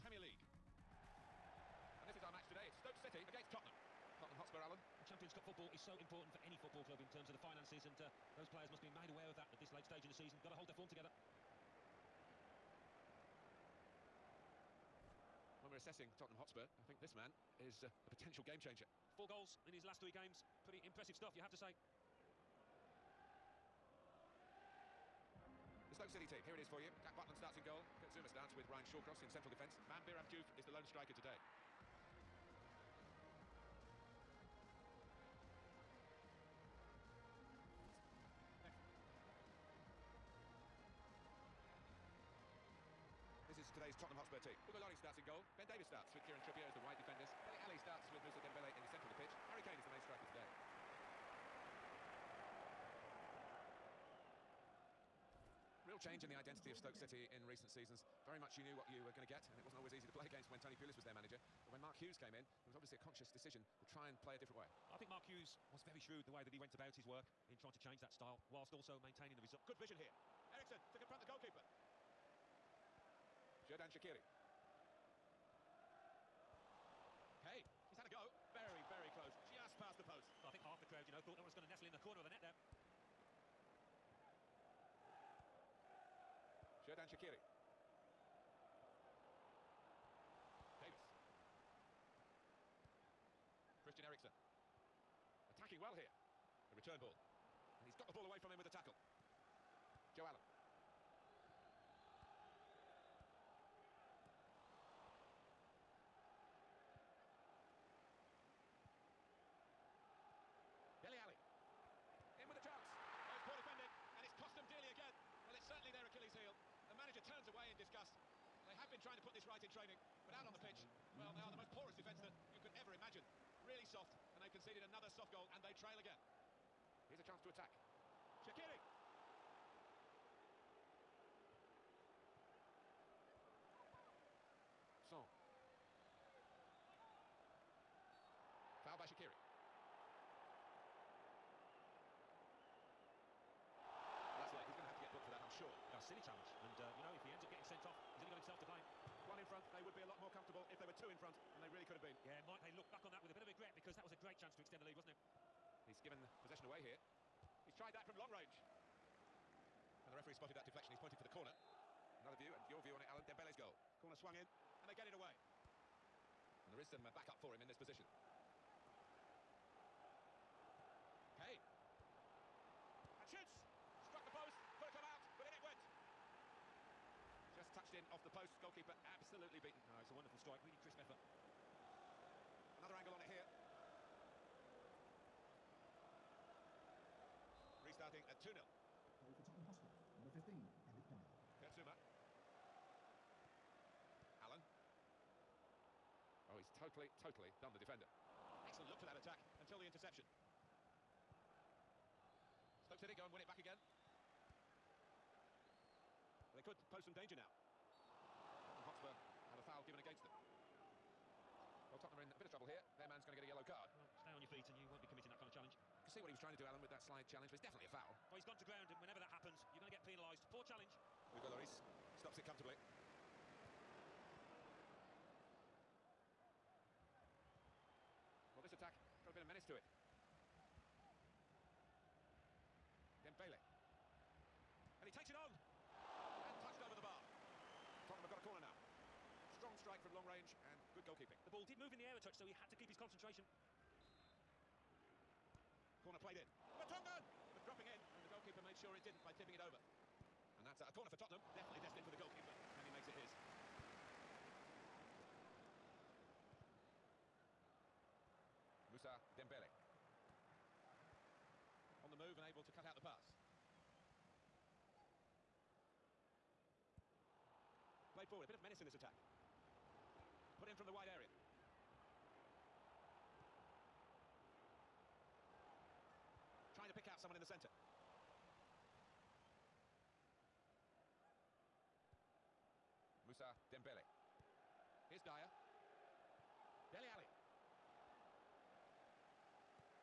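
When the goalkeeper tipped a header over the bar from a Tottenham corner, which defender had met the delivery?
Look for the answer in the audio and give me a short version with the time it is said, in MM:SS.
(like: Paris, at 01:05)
Vertonghen, at 04:06.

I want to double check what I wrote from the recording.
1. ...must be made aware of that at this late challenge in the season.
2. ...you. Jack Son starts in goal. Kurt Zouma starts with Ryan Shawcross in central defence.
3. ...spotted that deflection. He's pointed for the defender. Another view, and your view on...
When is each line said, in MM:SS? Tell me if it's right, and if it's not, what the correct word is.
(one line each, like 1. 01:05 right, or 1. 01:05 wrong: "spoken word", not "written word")
1. 00:08 wrong: "stage", not "challenge"
2. 00:26 wrong: "Butland", not "Son"
3. 02:40 wrong: "corner", not "defender".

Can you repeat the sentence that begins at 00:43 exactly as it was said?
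This is today's Tottenham Hotspur team.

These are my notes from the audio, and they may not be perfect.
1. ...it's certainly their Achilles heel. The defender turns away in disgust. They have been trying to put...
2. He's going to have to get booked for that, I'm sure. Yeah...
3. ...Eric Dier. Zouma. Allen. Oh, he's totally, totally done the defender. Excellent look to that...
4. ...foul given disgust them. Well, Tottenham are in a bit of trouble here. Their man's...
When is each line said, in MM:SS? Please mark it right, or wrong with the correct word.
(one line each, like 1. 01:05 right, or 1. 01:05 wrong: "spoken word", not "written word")
1. 01:55 wrong: "manager", not "defender"
2. 02:24 right
3. 03:10 right
4. 03:29 wrong: "against", not "disgust".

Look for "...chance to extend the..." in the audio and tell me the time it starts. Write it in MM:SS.
02:34.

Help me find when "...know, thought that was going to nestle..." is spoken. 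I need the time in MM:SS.
01:21.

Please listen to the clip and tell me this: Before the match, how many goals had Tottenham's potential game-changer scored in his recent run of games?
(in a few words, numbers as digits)
4.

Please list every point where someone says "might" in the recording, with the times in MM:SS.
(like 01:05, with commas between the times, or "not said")
02:32.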